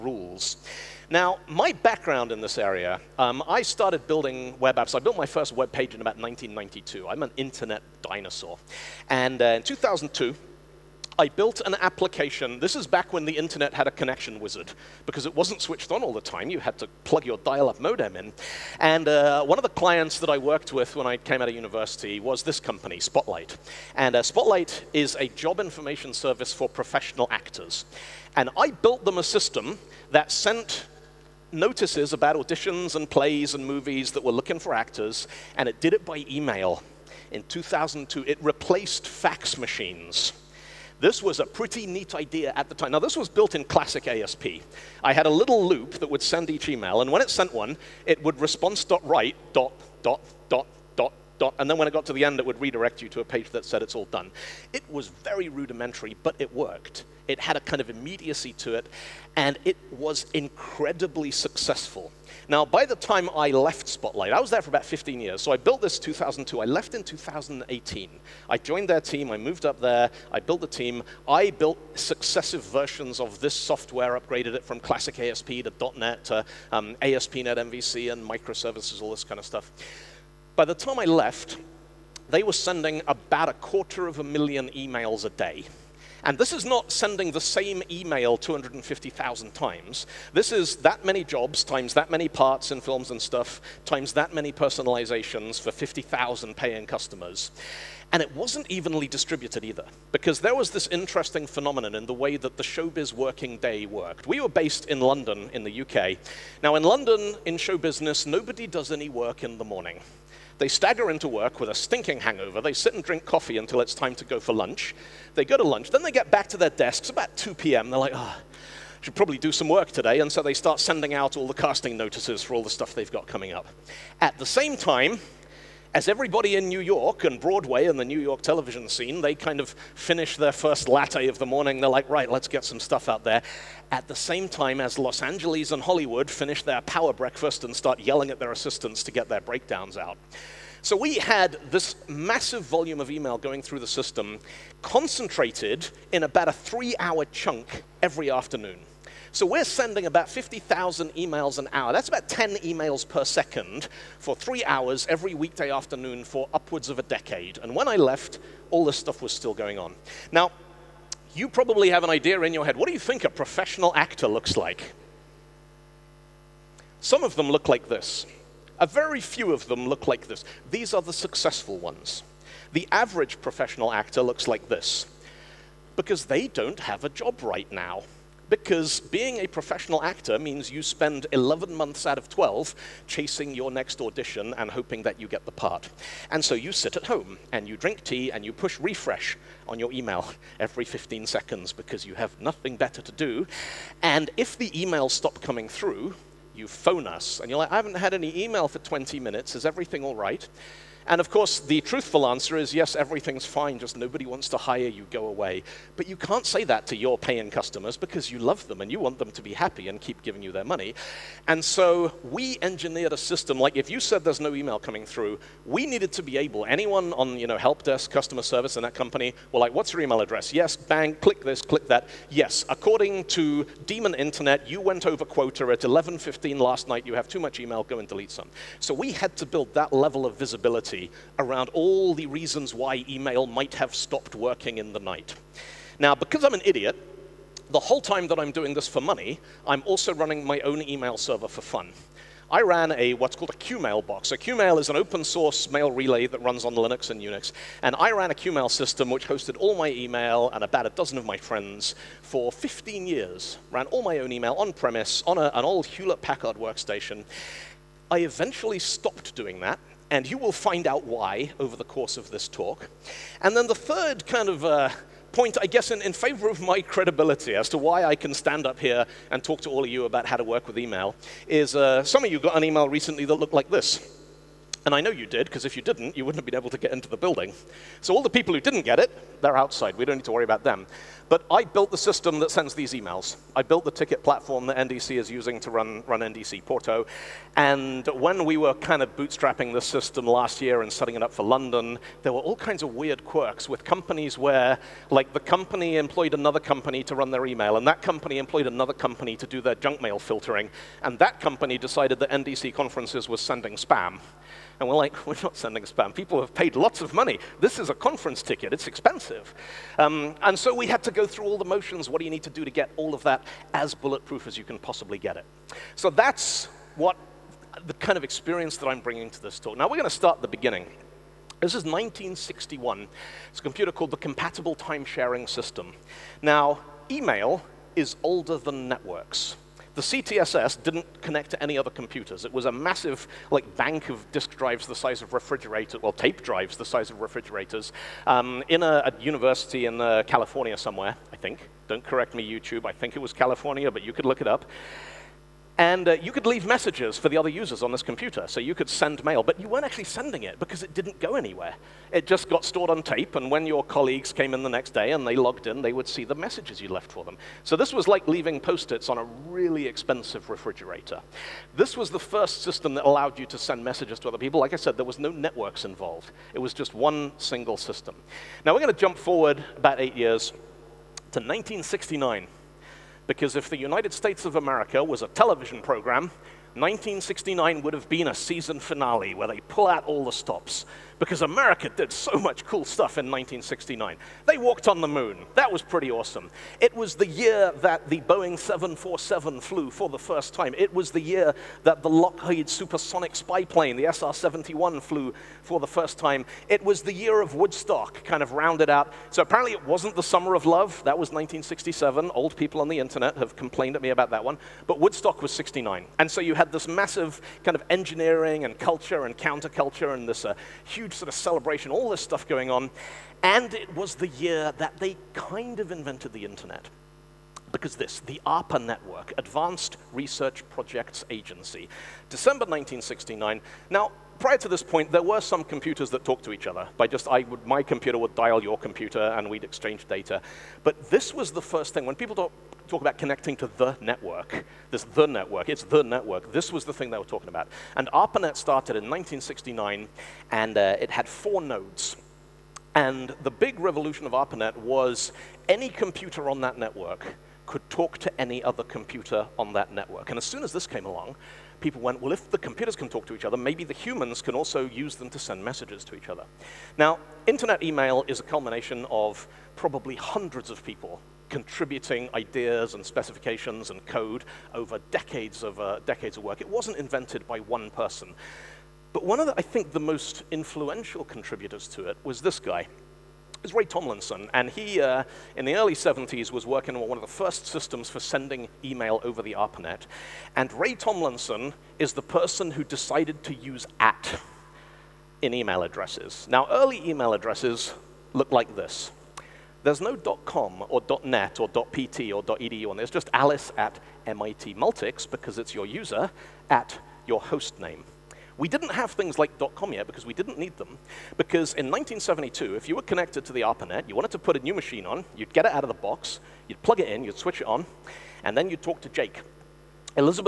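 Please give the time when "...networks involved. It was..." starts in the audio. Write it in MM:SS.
06:05.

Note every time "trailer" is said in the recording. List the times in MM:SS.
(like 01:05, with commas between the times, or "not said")
not said.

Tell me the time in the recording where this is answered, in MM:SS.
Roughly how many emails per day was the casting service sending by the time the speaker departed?
01:23.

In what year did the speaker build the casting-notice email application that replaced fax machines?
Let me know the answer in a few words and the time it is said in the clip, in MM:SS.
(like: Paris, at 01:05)
2002, at 00:37.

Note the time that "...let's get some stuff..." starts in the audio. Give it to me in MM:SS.
02:12.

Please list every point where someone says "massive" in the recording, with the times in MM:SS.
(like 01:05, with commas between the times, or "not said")
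02:22, 05:32, 06:46.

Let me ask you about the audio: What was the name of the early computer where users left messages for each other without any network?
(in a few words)
Compatible Time Sharing System.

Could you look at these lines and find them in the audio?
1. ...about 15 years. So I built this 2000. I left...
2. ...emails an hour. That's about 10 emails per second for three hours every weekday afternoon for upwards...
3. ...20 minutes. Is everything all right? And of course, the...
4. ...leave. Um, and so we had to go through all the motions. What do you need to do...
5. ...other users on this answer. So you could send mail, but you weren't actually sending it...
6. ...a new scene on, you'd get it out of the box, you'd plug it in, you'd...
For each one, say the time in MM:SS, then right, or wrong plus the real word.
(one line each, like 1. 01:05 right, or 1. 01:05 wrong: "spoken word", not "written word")
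1. 01:04 wrong: "2002", not "2000"
2. 02:31 right
3. 03:18 right
4. 05:08 wrong: "expensive", not "leave"
5. 05:47 wrong: "computer", not "answer"
6. 08:24 wrong: "machine", not "scene".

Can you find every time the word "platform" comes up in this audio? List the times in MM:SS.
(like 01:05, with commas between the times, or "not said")
04:44.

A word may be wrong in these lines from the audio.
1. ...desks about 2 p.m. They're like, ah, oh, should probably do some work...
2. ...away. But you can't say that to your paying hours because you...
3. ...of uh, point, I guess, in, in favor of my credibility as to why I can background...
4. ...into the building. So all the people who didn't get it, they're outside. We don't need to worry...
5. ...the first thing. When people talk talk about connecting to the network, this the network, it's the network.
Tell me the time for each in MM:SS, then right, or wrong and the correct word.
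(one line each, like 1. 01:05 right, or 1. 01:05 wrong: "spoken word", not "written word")
1. 01:56 right
2. 03:25 wrong: "customers", not "hours"
3. 04:24 wrong: "stand", not "background"
4. 04:36 right
5. 07:11 right.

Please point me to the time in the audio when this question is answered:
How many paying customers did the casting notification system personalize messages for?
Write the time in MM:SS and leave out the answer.
01:35.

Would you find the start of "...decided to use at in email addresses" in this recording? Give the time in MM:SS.
08:02.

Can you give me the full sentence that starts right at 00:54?
It was very rudimentary, but it worked.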